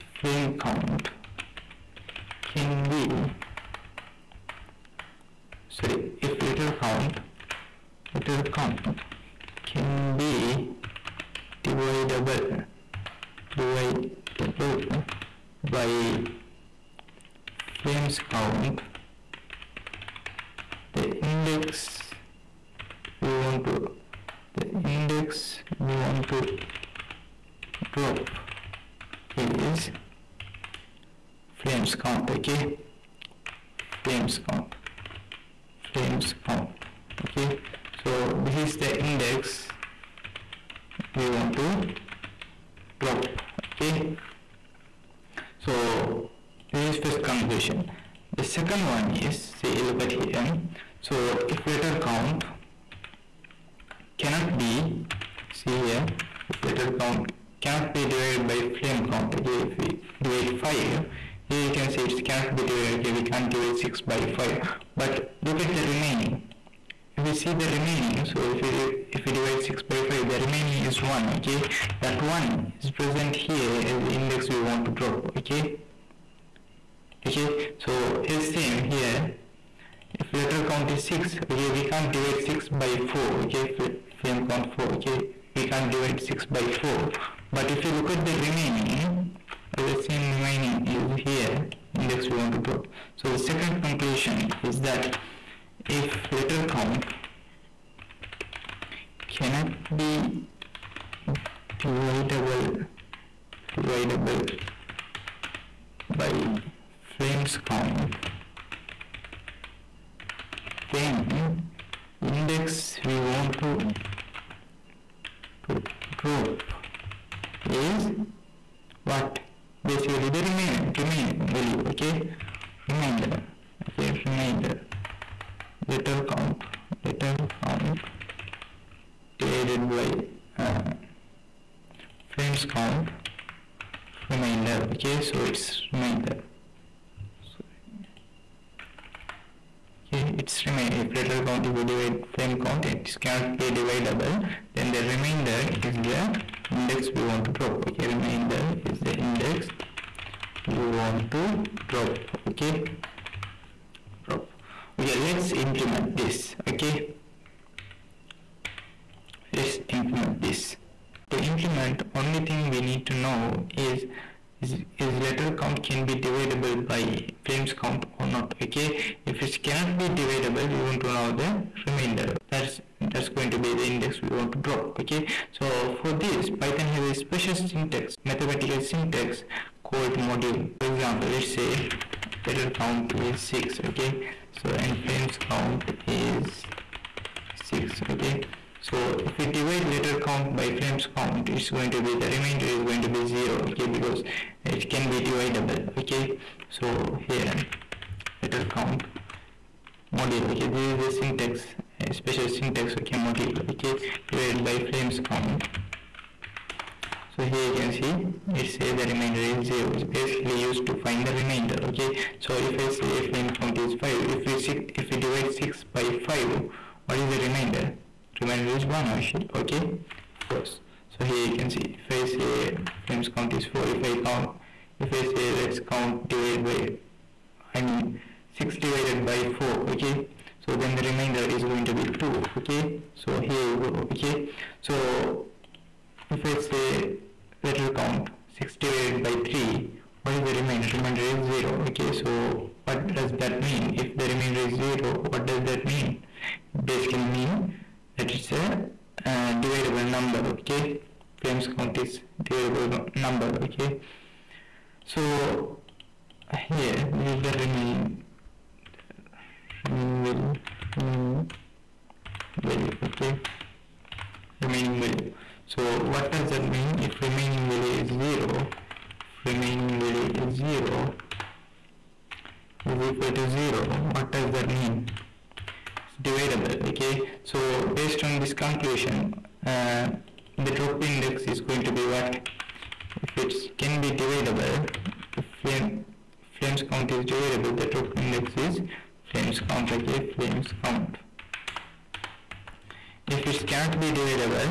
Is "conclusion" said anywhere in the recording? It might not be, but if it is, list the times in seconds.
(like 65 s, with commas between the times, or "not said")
47 s, 93 s, 278 s.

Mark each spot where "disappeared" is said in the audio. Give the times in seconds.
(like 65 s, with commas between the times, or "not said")
not said.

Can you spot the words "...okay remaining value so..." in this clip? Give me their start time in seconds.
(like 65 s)
263 s.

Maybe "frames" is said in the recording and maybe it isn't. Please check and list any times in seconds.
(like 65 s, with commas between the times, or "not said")
84 s, 132 s, 142 s, 167 s, 185 s, 190 s, 213 s.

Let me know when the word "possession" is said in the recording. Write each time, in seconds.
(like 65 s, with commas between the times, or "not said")
not said.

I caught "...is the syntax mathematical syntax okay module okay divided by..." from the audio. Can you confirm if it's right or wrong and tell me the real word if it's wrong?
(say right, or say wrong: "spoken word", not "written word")
wrong: "special", not "mathematical".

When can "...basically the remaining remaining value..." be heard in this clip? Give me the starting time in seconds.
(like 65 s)
119 s.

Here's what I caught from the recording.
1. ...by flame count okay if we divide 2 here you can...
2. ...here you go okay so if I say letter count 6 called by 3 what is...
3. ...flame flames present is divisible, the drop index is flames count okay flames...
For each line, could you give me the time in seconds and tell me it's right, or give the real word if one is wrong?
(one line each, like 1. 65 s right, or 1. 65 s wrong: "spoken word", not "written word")
1. 58 s wrong: "5", not "2"
2. 233 s wrong: "divided", not "called"
3. 285 s wrong: "count", not "present".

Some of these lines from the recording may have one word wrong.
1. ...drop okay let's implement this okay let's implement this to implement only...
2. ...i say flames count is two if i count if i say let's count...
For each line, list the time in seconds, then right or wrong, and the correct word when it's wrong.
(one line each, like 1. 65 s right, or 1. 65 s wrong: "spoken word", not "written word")
1. 154 s right
2. 222 s wrong: "four", not "two".